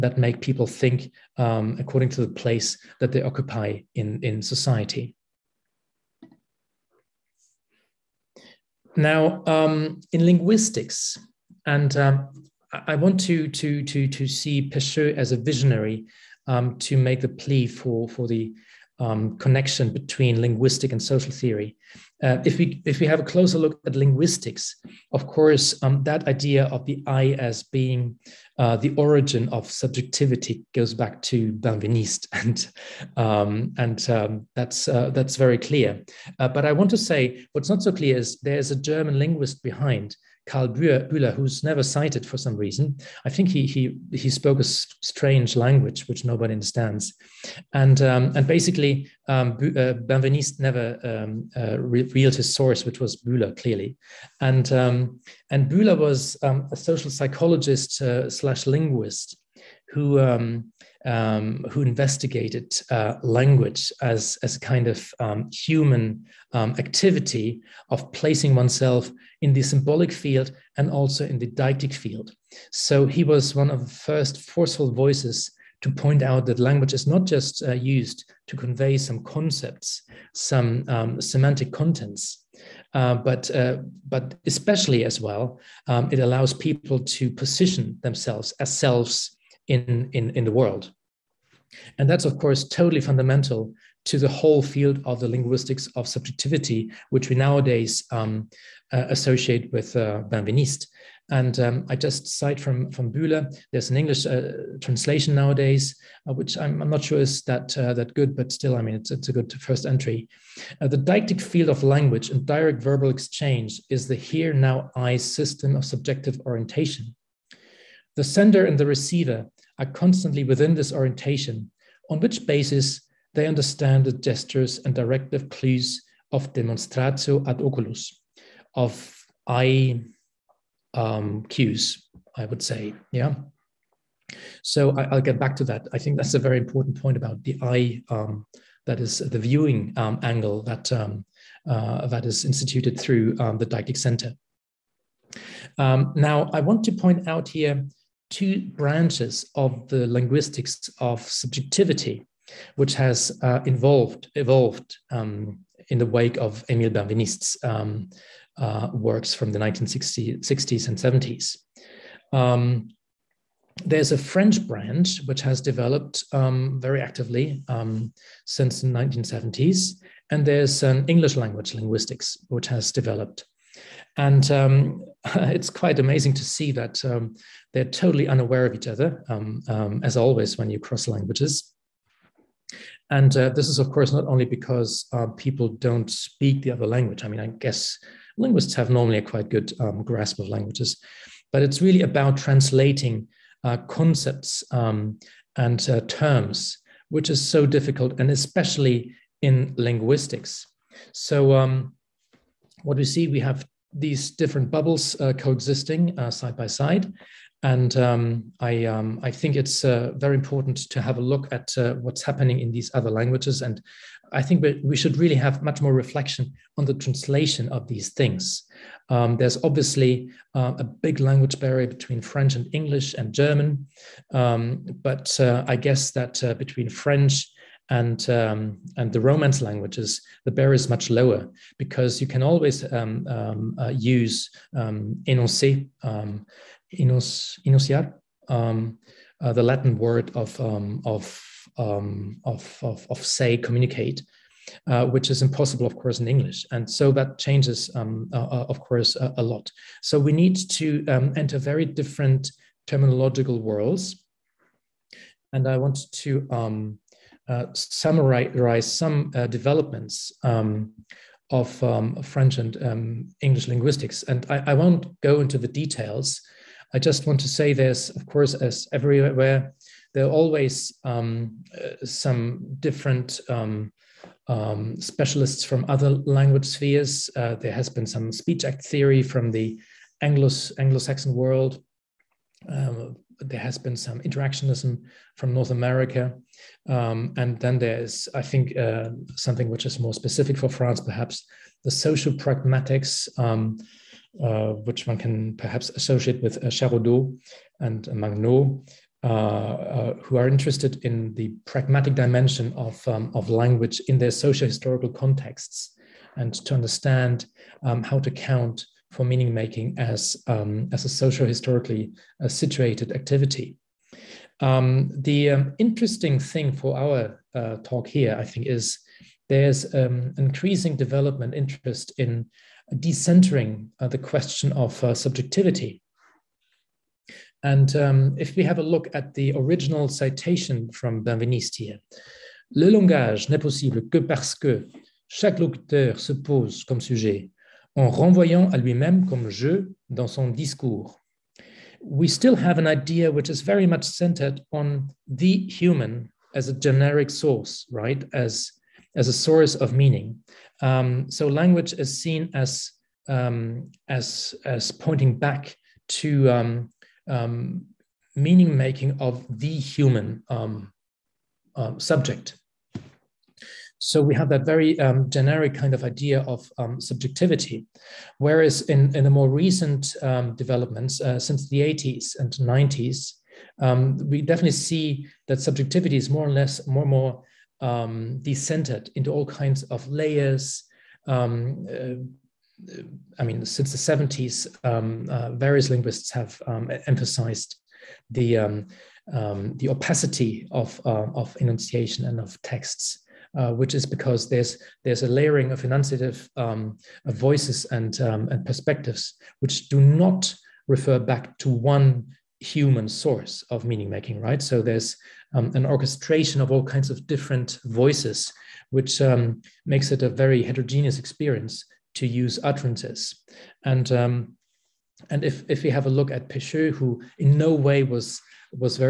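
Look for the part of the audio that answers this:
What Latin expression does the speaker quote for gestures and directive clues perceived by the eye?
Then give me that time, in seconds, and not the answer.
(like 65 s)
126 s.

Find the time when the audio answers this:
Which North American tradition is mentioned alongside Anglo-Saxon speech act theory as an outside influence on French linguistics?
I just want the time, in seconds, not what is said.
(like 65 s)
284 s.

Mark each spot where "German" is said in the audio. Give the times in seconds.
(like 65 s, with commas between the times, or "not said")
38 s, 223 s.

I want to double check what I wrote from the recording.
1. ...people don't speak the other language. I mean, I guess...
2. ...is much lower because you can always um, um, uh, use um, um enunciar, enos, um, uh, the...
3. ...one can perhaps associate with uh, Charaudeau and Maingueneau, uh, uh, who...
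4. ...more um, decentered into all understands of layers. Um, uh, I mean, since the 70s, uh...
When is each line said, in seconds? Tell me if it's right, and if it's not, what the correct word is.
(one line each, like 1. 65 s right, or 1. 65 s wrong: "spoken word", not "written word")
1. 185 s right
2. 230 s right
3. 295 s right
4. 377 s wrong: "kinds", not "understands".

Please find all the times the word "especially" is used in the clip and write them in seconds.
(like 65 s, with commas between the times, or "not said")
84 s, 198 s.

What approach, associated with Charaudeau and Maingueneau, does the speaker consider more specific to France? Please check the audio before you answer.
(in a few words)
social pragmatics.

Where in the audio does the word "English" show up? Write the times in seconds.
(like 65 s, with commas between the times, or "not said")
103 s, 171 s, 222 s, 246 s, 263 s.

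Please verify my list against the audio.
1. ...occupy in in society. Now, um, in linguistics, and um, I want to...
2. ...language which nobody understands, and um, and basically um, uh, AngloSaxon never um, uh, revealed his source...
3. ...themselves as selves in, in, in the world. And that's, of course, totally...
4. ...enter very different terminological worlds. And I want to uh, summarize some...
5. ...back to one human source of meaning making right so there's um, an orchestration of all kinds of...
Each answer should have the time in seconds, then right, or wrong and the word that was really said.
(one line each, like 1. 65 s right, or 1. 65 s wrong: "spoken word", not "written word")
1. 3 s right
2. 45 s wrong: "Benveniste", not "AngloSaxon"
3. 88 s right
4. 251 s right
5. 401 s right.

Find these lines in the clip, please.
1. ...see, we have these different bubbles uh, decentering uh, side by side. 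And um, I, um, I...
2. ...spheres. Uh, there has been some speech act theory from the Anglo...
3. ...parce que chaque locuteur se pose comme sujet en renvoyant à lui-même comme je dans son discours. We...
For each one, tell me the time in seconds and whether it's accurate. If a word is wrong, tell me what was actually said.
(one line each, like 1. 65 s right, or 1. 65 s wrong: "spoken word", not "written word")
1. 203 s wrong: "coexisting", not "decentering"
2. 276 s right
3. 334 s right.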